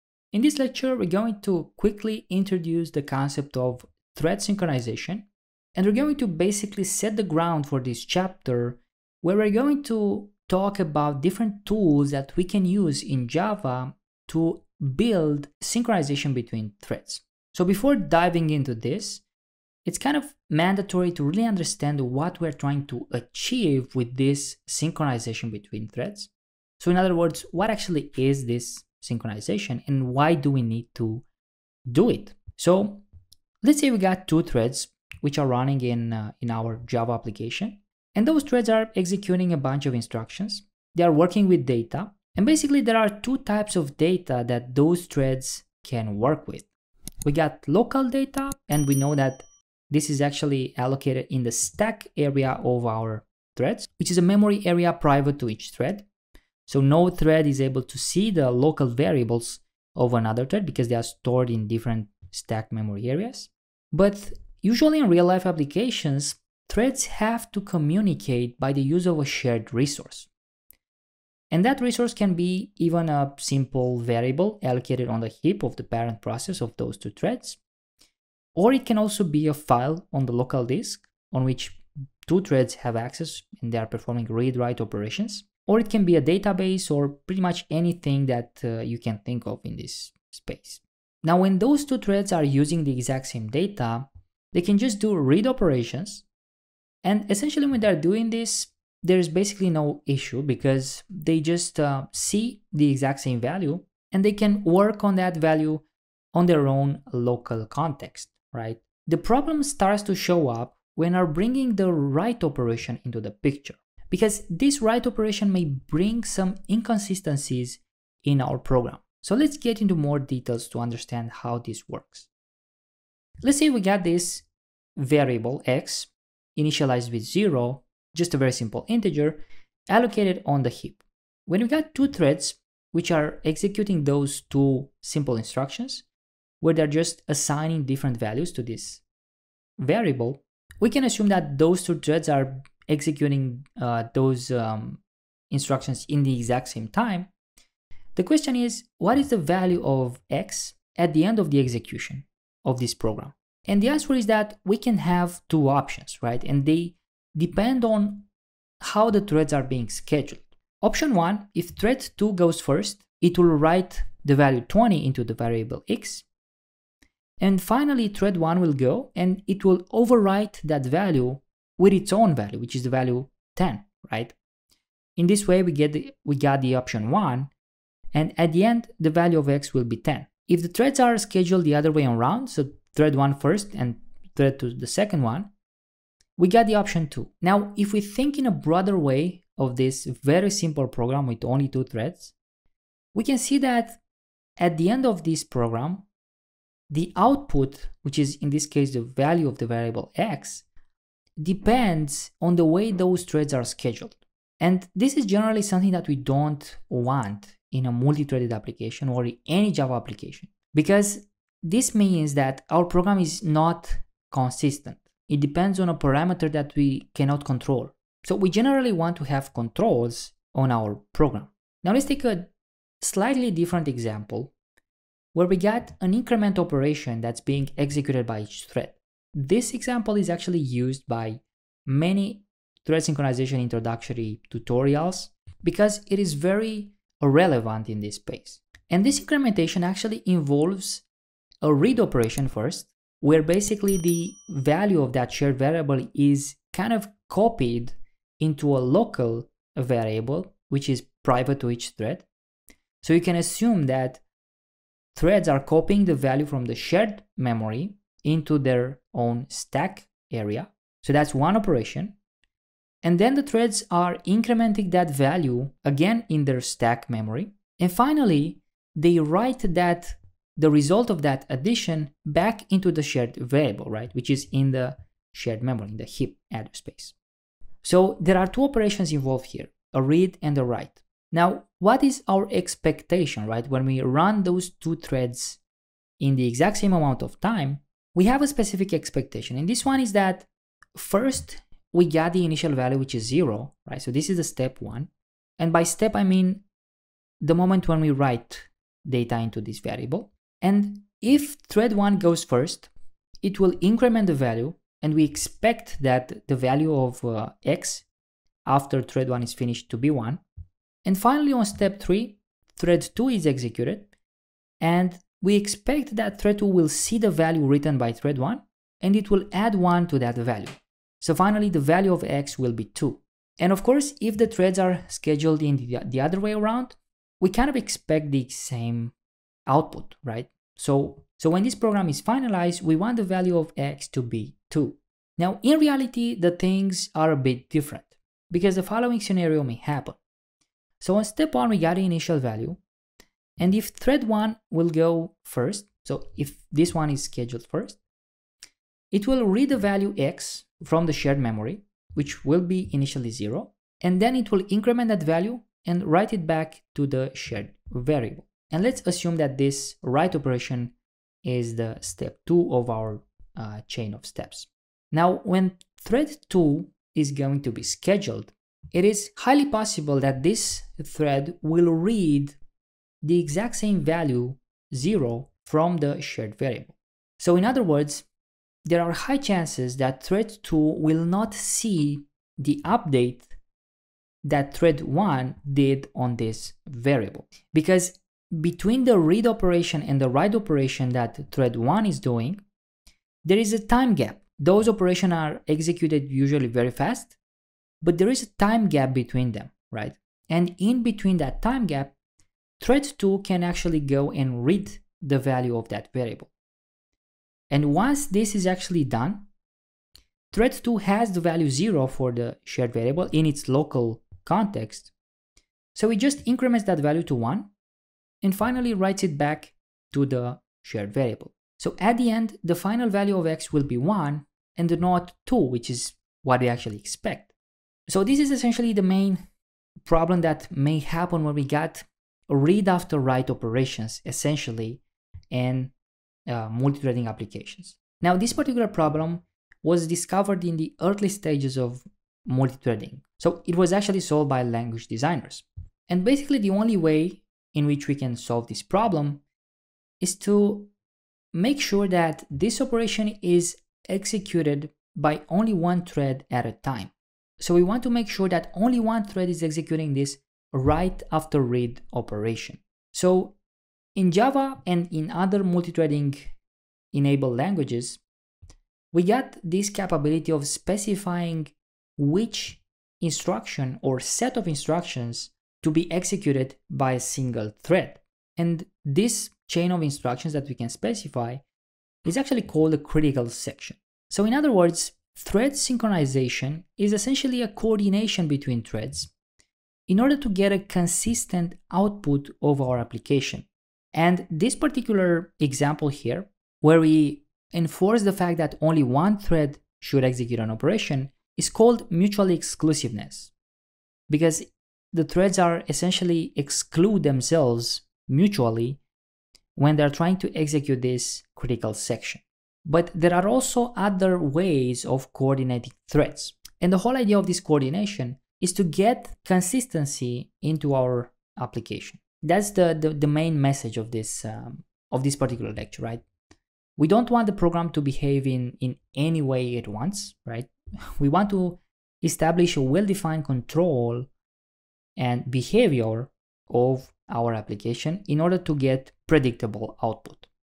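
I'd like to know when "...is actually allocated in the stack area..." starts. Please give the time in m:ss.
0:50.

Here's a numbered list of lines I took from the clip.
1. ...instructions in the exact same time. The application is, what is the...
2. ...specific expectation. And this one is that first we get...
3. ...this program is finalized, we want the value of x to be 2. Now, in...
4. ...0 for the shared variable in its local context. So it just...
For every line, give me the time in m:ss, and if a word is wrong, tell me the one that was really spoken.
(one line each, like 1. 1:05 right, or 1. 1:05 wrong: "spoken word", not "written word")
1. 2:25 wrong: "question", not "application"
2. 4:48 right
3. 5:31 right
4. 6:51 right.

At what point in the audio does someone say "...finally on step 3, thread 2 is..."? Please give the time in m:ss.
5:11.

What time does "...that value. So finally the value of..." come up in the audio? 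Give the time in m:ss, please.
5:20.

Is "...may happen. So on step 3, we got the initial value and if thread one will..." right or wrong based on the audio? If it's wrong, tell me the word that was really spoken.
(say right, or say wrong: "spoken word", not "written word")
wrong: "1", not "3".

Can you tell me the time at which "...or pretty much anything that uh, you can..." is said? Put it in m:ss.
1:26.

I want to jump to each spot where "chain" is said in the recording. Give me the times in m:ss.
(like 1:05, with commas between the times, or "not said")
6:03, 7:59.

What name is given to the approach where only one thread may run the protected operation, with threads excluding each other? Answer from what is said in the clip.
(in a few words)
Mutual exclusiveness.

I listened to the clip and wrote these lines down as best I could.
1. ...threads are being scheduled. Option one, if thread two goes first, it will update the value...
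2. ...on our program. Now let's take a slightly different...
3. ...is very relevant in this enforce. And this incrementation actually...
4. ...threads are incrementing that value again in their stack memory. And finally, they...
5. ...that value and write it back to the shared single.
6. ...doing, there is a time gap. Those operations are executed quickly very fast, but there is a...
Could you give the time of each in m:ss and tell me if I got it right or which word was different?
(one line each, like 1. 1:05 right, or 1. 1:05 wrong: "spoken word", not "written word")
1. 2:39 wrong: "write", not "update"
2. 3:40 right
3. 3:56 wrong: "space", not "enforce"
4. 4:23 right
5. 5:55 wrong: "variable", not "single"
6. 6:32 wrong: "usually", not "quickly".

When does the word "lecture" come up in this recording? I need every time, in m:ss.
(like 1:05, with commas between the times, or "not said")
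0:00, 8:45.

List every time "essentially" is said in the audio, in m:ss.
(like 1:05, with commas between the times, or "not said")
1:37, 7:08, 7:14, 8:07, 8:25.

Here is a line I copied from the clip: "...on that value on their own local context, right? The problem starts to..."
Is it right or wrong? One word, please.
right.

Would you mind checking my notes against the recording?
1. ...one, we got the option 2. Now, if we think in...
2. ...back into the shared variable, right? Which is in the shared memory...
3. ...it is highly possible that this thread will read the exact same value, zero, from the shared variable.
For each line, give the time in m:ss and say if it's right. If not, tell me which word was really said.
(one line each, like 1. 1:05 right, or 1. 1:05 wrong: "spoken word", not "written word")
1. 3:05 right
2. 4:32 right
3. 6:08 right.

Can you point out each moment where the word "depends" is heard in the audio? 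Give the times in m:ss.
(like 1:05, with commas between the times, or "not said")
2:37, 3:21, 3:35.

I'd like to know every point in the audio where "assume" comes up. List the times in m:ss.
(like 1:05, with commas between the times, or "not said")
2:21, 4:13, 5:59.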